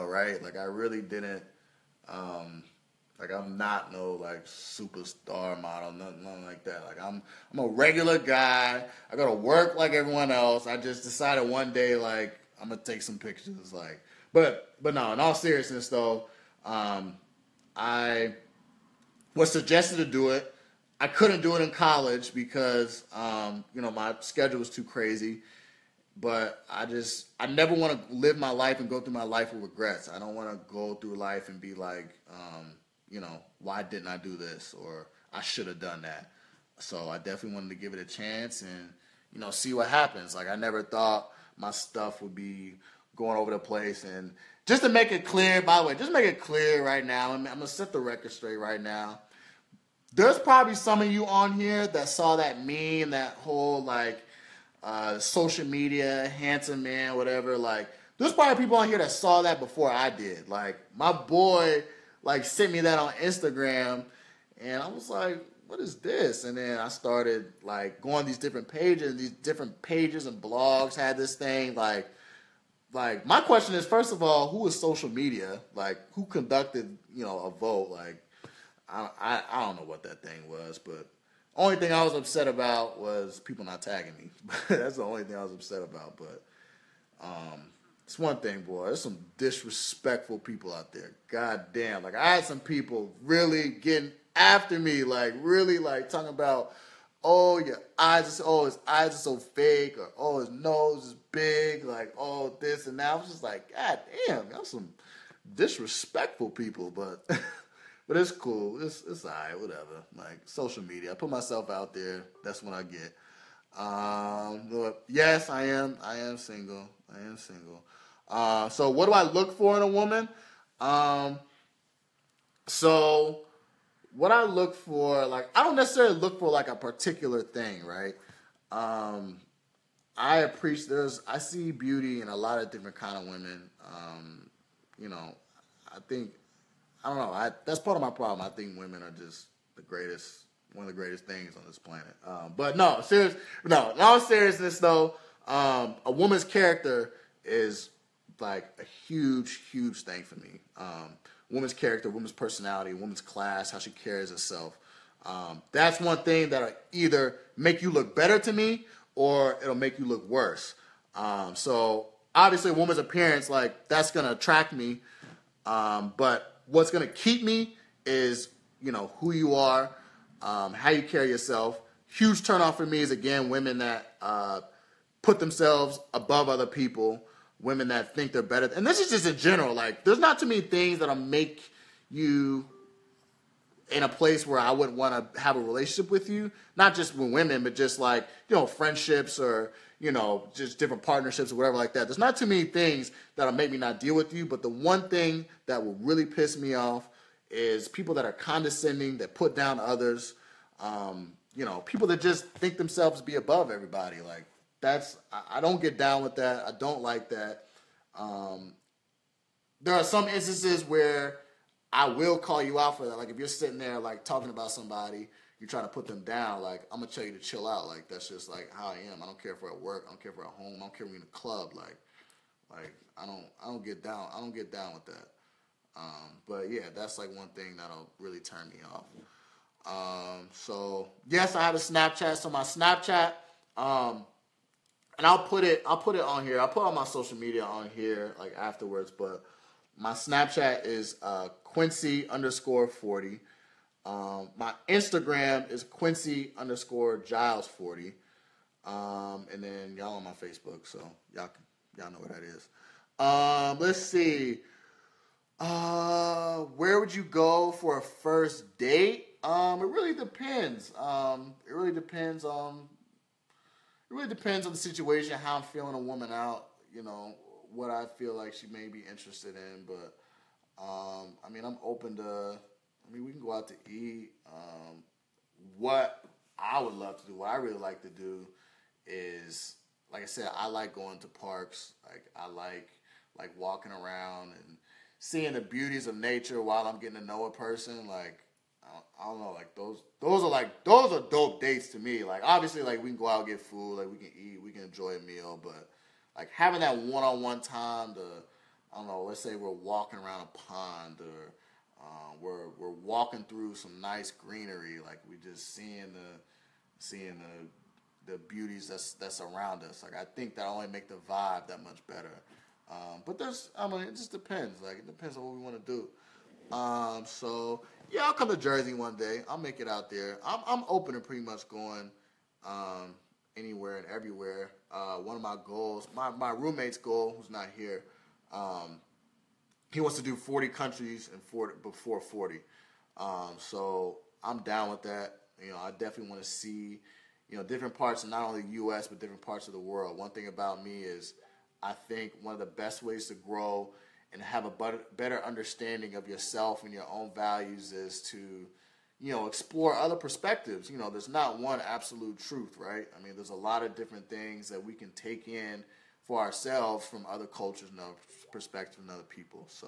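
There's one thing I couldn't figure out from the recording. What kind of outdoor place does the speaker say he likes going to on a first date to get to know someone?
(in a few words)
parks.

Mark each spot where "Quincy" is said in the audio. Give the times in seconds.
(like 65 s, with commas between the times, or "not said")
241 s, 245 s.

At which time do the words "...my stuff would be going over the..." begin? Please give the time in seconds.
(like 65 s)
41 s.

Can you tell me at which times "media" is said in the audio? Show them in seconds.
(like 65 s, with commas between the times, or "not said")
55 s, 75 s, 110 s, 237 s.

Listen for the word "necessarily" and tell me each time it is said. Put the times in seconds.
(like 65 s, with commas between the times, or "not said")
125 s.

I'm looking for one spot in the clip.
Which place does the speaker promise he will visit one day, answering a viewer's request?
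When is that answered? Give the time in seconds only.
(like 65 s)
318 s.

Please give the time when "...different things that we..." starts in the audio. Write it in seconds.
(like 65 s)
353 s.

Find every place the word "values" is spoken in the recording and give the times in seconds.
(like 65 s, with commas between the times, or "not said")
347 s.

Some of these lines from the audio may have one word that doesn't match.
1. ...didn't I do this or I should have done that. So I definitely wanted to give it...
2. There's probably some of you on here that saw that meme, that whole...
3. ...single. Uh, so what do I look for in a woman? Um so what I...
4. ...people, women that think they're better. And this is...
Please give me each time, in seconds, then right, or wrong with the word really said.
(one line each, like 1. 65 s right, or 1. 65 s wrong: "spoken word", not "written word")
1. 33 s right
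2. 50 s right
3. 117 s right
4. 176 s right.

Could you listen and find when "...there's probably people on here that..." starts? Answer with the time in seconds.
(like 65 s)
58 s.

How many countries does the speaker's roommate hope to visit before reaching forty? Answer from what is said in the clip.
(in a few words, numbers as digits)
40 countries.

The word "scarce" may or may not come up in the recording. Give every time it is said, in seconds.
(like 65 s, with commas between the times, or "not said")
not said.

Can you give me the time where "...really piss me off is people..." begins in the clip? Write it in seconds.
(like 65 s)
196 s.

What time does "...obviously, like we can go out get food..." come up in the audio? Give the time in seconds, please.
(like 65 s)
292 s.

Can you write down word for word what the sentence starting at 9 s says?
I go to work like everyone else.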